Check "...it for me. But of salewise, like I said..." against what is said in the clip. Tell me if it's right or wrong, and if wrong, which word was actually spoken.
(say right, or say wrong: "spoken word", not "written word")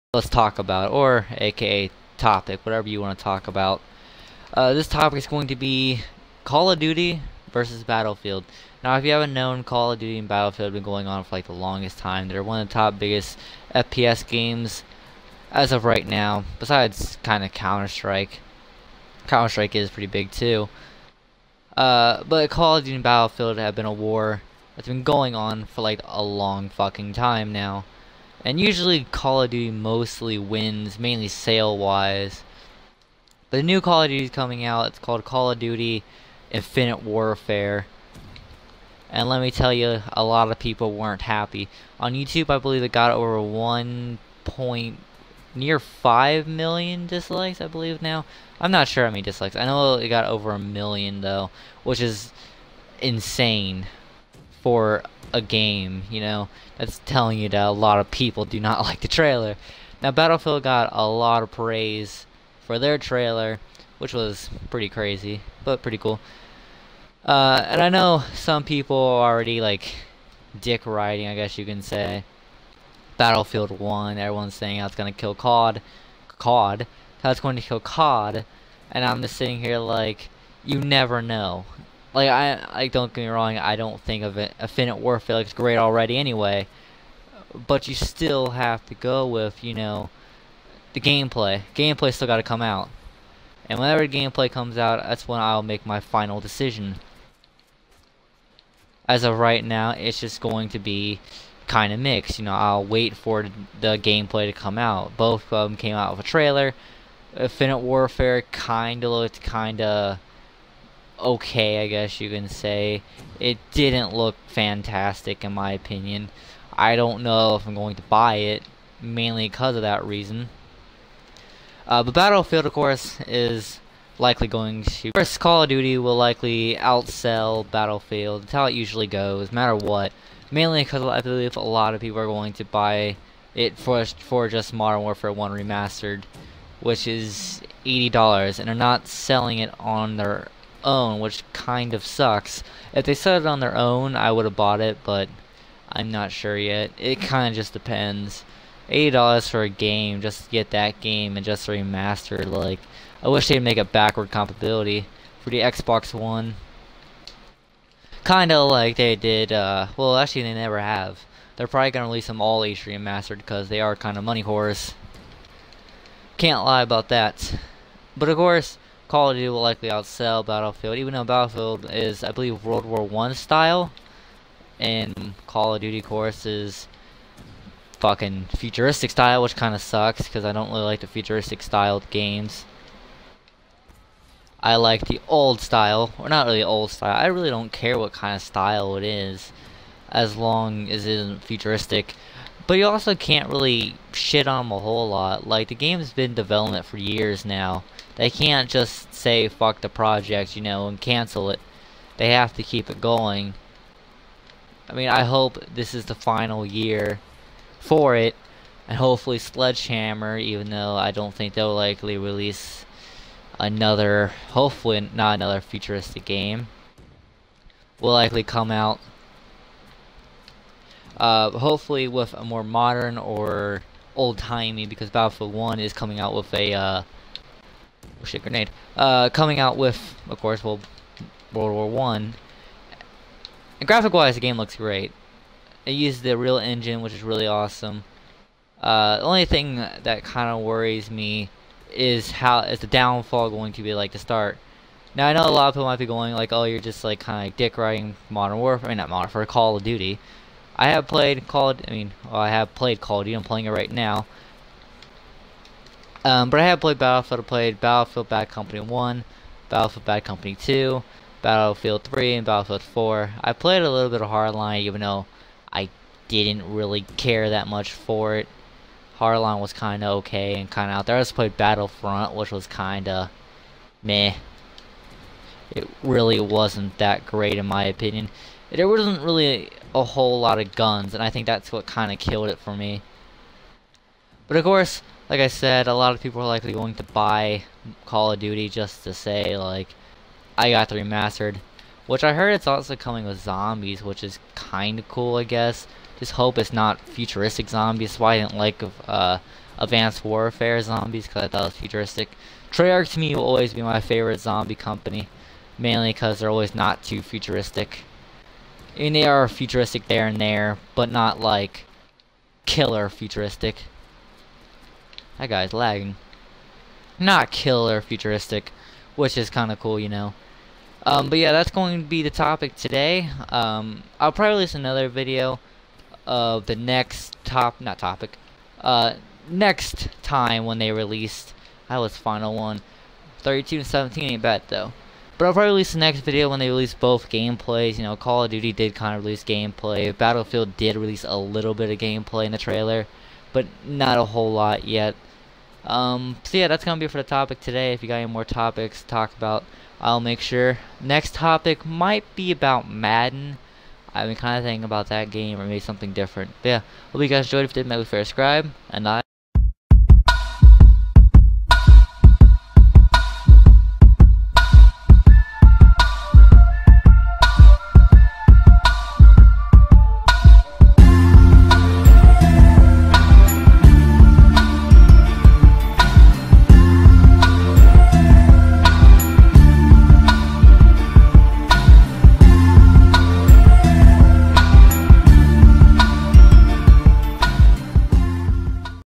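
wrong: "course", not "salewise".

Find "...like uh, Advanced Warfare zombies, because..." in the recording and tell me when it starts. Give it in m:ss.
4:58.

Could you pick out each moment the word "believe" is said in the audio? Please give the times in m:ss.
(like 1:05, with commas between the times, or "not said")
0:42, 0:47, 2:11, 2:52.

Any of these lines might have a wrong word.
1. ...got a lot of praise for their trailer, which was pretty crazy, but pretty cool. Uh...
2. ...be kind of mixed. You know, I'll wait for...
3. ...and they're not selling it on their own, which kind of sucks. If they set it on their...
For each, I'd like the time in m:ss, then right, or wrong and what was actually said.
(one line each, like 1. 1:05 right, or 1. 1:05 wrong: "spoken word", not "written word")
1. 1:00 right
2. 1:40 right
3. 2:18 right.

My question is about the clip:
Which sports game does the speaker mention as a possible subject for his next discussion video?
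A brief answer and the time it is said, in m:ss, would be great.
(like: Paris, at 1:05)
Madden, at 5:52.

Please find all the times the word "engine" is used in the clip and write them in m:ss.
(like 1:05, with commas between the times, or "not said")
3:56.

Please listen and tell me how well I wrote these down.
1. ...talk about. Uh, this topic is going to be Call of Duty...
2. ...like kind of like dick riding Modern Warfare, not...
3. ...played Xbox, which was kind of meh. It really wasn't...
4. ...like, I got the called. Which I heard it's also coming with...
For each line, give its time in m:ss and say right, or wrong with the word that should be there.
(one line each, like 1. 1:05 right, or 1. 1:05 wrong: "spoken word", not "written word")
1. 0:03 right
2. 4:07 right
3. 4:31 wrong: "Battlefront", not "Xbox"
4. 4:49 wrong: "remastered", not "called".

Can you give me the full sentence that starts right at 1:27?
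But you still have to go with, you know, the gameplay.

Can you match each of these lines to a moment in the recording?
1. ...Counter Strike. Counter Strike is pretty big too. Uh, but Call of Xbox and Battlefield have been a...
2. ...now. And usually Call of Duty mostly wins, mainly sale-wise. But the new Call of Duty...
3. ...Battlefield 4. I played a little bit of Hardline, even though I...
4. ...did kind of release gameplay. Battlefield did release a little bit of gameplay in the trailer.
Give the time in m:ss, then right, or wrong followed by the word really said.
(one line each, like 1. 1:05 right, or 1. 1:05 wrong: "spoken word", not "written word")
1. 0:17 wrong: "Duty", not "Xbox"
2. 0:27 right
3. 4:22 right
4. 5:38 right.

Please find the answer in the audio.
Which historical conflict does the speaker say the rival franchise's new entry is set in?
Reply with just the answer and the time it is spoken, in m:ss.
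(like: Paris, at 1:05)
World War 1, at 3:51.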